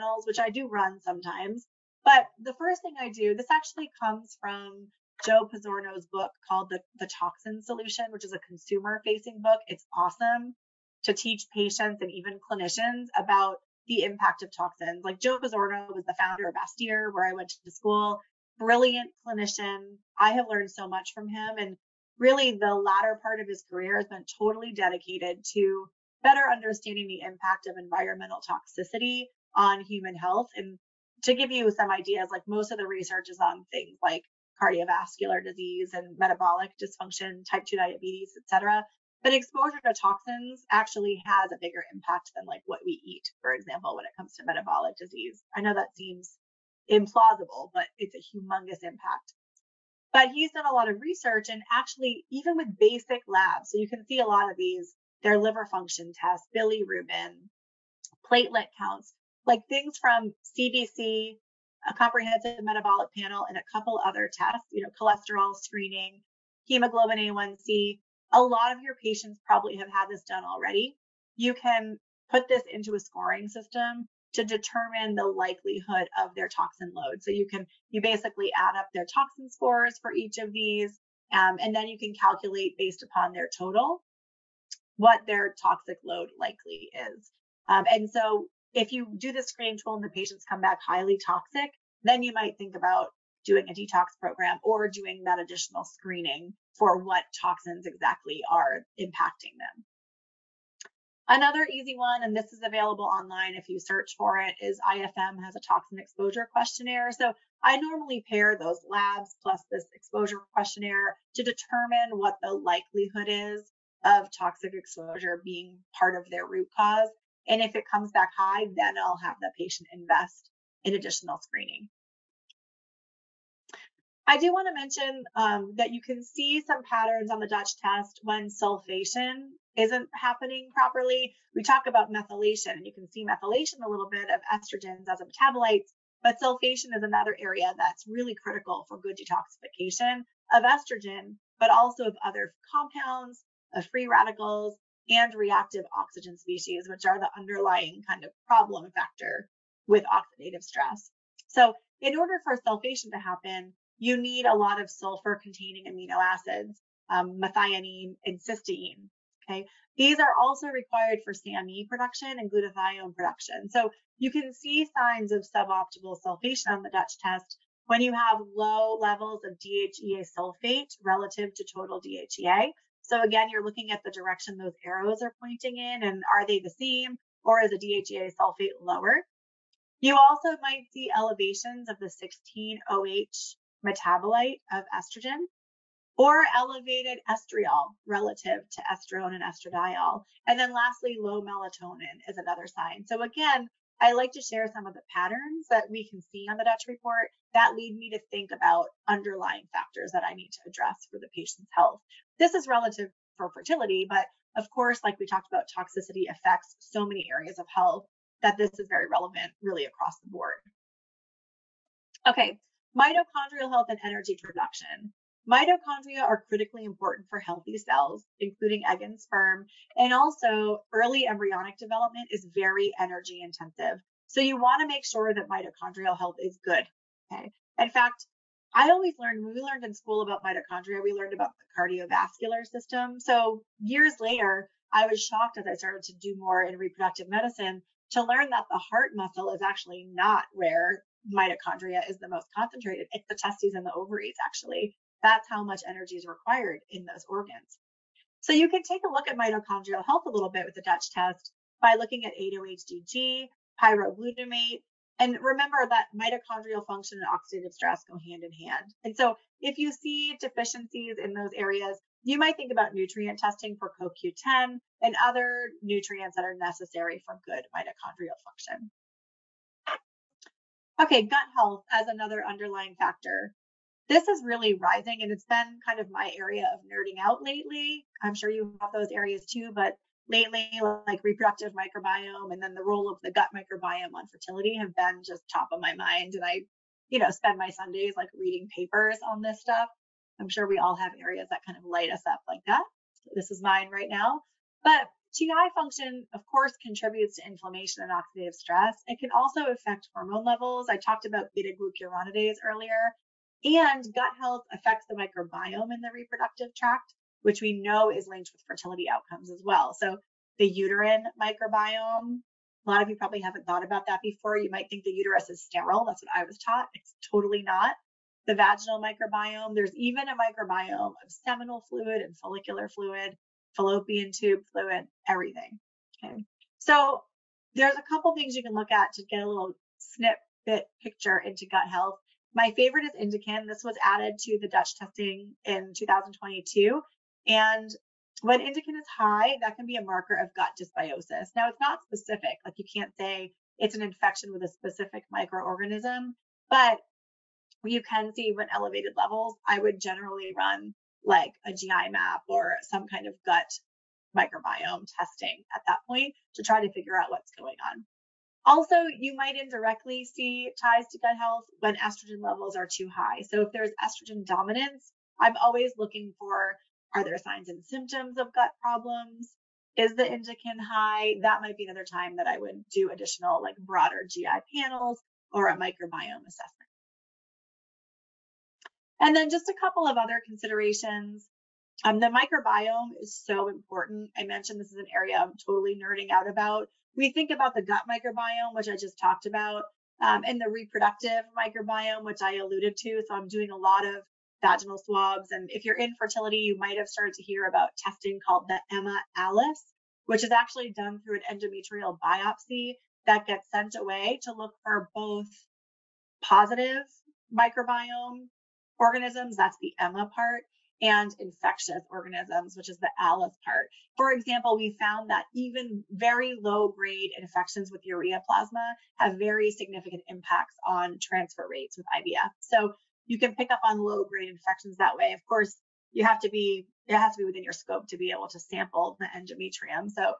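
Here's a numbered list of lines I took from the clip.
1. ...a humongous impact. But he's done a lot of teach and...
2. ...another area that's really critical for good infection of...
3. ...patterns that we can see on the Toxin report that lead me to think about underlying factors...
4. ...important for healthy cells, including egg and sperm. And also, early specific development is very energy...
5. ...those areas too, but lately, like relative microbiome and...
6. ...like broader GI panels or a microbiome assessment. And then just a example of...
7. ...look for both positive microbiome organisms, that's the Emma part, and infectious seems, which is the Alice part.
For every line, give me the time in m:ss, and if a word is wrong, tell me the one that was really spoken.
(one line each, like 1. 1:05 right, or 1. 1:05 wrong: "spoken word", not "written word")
1. 0:48 wrong: "research", not "teach"
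2. 2:17 wrong: "detoxification", not "infection"
3. 3:15 wrong: "Dutch", not "Toxin"
4. 3:36 wrong: "embryonic", not "specific"
5. 4:38 wrong: "reproductive", not "relative"
6. 6:13 wrong: "couple", not "example"
7. 6:44 wrong: "organisms", not "seems".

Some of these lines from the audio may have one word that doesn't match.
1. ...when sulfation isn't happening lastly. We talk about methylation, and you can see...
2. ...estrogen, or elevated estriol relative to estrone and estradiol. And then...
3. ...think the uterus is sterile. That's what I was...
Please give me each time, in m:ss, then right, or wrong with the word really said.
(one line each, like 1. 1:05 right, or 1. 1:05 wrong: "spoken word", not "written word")
1. 2:08 wrong: "properly", not "lastly"
2. 3:04 right
3. 5:14 right.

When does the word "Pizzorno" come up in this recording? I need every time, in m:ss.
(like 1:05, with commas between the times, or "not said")
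0:05, 0:15.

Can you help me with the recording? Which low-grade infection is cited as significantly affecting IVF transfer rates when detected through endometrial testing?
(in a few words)
Ureaplasma.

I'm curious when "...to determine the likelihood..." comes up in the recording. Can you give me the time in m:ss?
1:14.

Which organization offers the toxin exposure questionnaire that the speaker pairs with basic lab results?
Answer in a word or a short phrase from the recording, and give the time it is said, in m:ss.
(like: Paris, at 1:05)
IFM, at 1:44.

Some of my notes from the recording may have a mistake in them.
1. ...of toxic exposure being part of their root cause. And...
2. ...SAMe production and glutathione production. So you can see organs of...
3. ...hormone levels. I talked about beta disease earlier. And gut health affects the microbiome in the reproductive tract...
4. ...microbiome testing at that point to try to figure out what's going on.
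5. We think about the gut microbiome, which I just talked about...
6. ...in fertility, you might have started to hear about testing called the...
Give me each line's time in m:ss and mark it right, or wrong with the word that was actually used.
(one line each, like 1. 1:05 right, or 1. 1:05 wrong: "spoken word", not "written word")
1. 1:54 right
2. 2:41 wrong: "signs", not "organs"
3. 5:00 wrong: "glucuronidase", not "disease"
4. 5:54 right
5. 6:27 right
6. 6:35 right.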